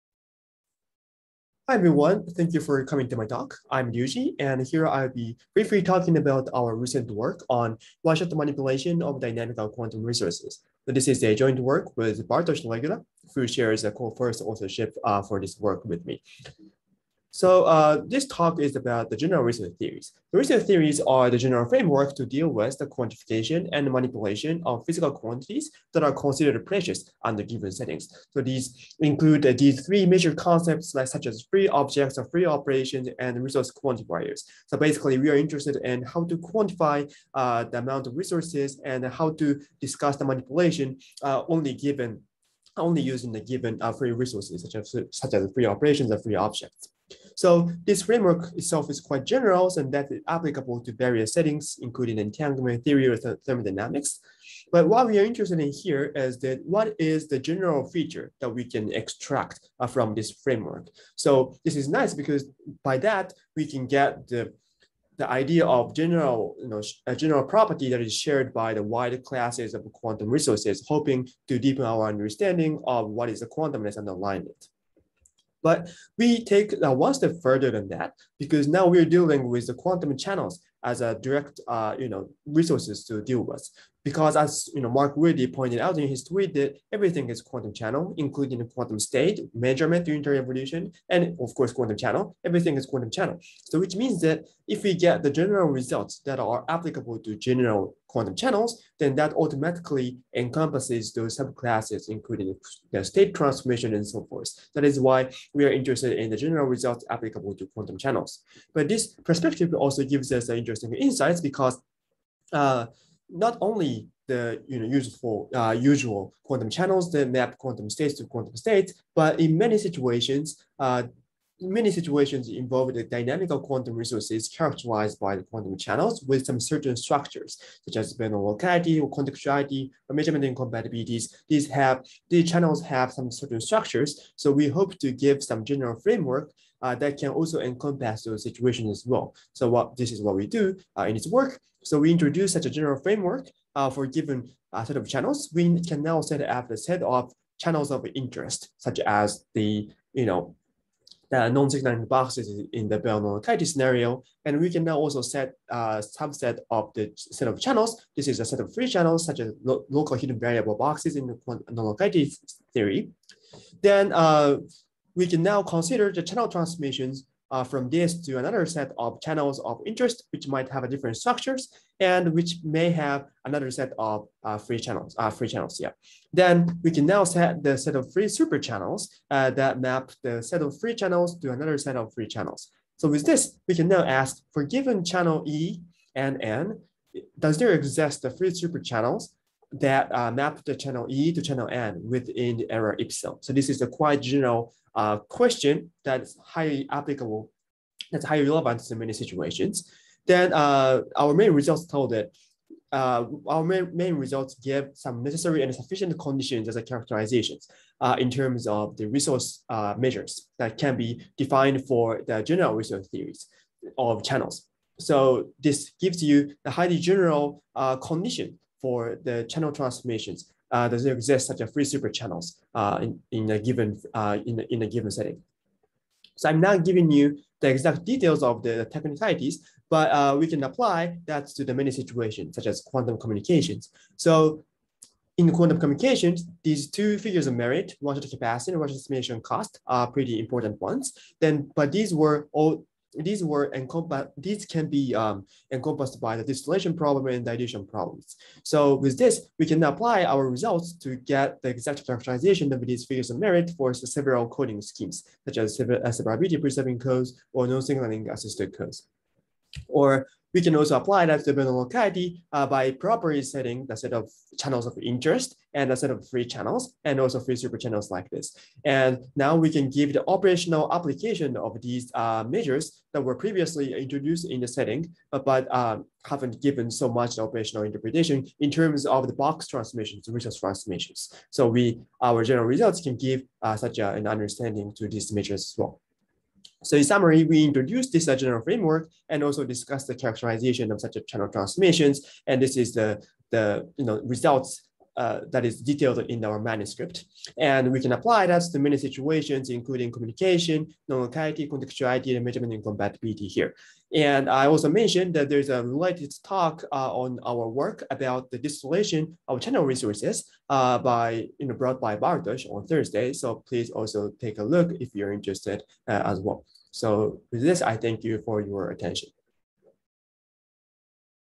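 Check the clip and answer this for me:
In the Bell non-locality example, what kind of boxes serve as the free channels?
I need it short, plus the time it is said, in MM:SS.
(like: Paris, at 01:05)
local hidden variable boxes, at 02:39.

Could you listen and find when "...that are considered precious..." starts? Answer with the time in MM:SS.
00:25.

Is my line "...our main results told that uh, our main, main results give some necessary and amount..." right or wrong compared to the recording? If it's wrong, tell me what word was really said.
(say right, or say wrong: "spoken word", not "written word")
wrong: "sufficient", not "amount".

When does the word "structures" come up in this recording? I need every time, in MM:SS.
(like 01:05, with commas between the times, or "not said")
02:06, 02:13, 02:51.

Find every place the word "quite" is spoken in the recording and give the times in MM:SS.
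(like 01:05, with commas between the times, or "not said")
00:48, 03:13.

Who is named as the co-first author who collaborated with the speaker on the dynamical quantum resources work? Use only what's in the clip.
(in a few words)
Bartosz Regula.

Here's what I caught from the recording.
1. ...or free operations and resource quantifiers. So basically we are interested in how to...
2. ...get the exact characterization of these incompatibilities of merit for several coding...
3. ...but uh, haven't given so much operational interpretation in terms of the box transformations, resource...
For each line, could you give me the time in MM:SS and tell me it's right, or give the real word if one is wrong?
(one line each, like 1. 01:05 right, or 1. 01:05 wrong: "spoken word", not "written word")
1. 00:32 right
2. 04:11 wrong: "figures", not "incompatibilities"
3. 04:35 right.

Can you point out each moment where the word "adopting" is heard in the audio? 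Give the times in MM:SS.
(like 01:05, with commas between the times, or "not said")
not said.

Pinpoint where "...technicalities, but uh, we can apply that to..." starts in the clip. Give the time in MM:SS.
03:48.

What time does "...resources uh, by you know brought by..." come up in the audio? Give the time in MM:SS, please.
05:09.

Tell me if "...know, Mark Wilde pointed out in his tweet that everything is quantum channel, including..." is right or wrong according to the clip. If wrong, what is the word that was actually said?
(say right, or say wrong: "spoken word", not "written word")
right.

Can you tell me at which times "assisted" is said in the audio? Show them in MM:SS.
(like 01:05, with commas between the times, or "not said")
04:18.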